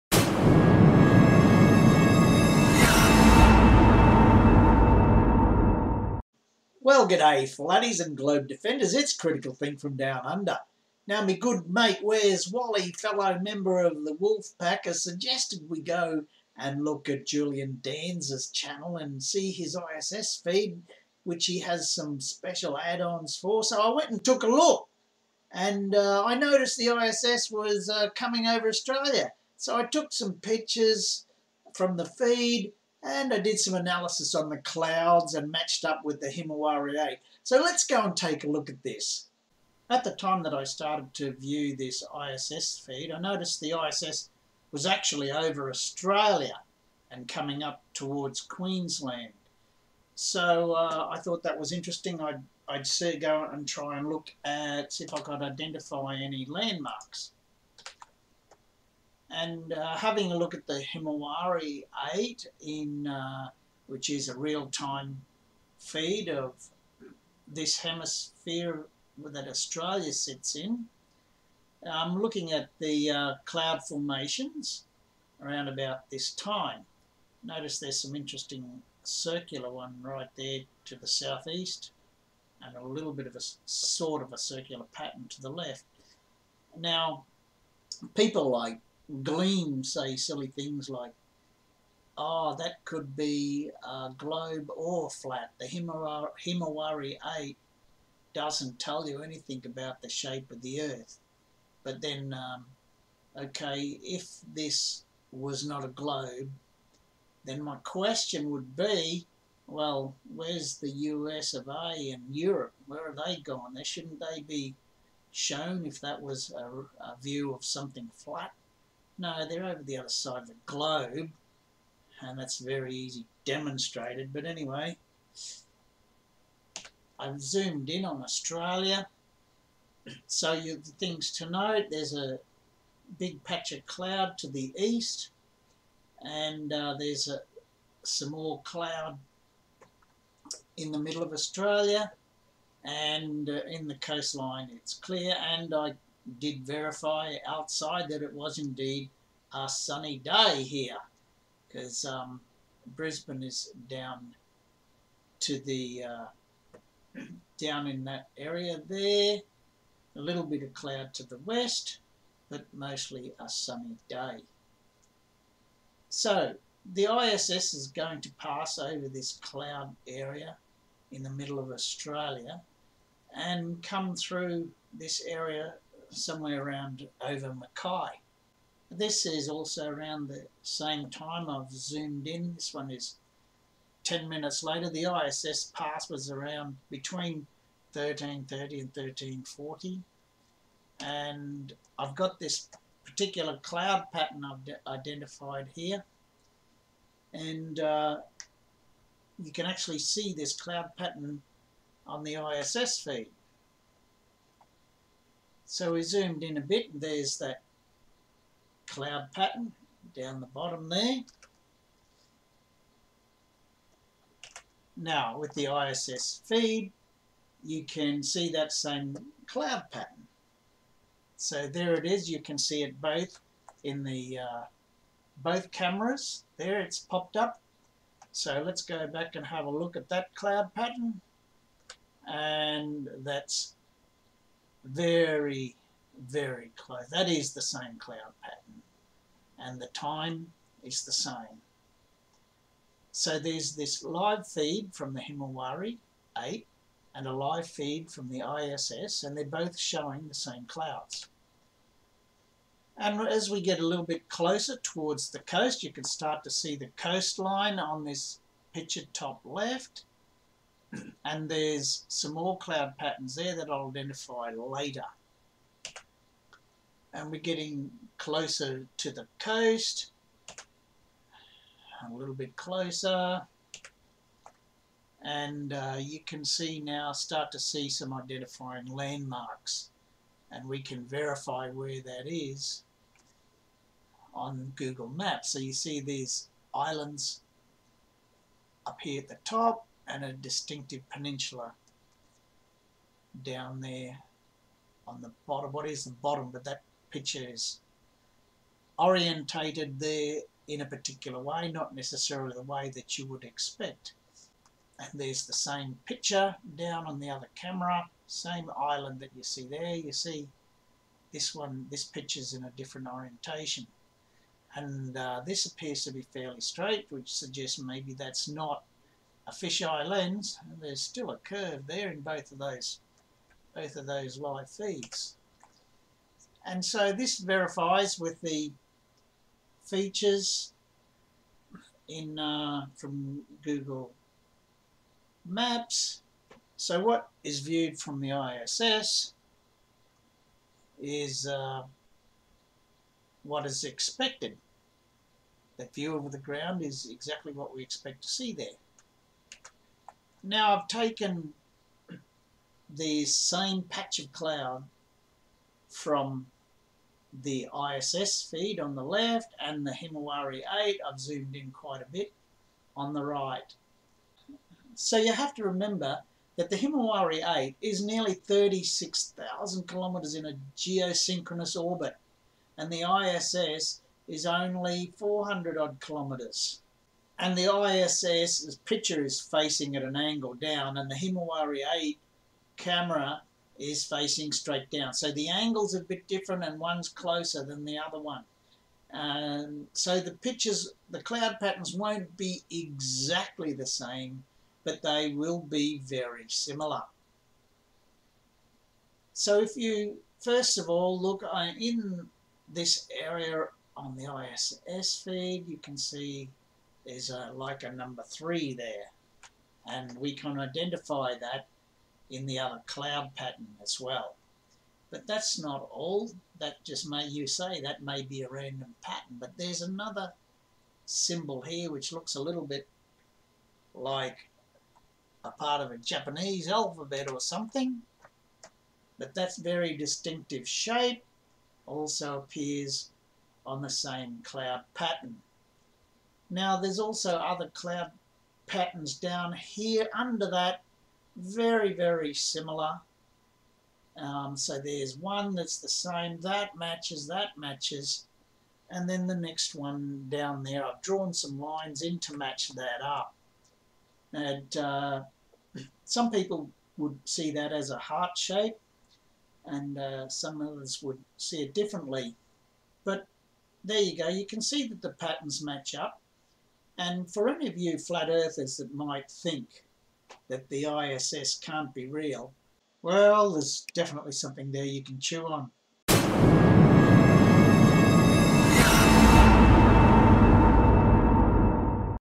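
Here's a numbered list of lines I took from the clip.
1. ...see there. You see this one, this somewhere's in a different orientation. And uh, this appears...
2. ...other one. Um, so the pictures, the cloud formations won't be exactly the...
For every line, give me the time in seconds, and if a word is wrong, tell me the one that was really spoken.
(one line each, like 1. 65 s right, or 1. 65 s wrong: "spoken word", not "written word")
1. 309 s wrong: "picture", not "somewhere"
2. 387 s wrong: "patterns", not "formations".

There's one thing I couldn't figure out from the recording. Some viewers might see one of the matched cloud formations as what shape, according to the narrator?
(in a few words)
Heart shape.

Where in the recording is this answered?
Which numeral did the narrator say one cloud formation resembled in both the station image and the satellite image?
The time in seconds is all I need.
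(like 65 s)
407 s.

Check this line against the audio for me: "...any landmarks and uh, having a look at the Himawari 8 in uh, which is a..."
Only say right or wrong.
right.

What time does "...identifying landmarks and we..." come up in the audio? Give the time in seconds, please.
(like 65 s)
278 s.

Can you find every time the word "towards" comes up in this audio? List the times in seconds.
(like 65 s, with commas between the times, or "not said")
47 s, 254 s.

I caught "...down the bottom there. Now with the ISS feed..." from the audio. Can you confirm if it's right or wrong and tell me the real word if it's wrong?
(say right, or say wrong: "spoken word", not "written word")
right.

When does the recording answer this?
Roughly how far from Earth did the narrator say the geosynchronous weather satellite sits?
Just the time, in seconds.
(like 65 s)
368 s.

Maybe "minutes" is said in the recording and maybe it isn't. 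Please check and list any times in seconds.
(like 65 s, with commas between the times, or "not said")
184 s.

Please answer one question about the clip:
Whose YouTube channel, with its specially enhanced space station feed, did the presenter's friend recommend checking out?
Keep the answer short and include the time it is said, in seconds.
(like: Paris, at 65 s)
Julian Danzer, at 17 s.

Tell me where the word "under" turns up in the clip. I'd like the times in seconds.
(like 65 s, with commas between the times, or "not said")
10 s, 440 s.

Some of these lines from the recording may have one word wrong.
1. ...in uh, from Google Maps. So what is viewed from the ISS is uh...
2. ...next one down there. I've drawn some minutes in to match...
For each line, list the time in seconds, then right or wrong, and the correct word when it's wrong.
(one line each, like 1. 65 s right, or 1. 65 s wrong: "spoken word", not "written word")
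1. 332 s right
2. 449 s wrong: "lines", not "minutes".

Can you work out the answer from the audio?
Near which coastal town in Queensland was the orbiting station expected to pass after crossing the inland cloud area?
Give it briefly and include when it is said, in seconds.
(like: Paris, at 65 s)
Mackay, at 177 s.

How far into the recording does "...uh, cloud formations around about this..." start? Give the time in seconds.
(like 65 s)
73 s.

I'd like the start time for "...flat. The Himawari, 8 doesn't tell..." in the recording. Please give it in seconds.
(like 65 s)
95 s.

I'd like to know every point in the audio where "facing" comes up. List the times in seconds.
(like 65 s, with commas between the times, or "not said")
379 s, 384 s.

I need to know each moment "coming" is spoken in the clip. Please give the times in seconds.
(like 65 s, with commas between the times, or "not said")
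28 s, 47 s.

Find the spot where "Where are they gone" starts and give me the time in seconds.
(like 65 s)
112 s.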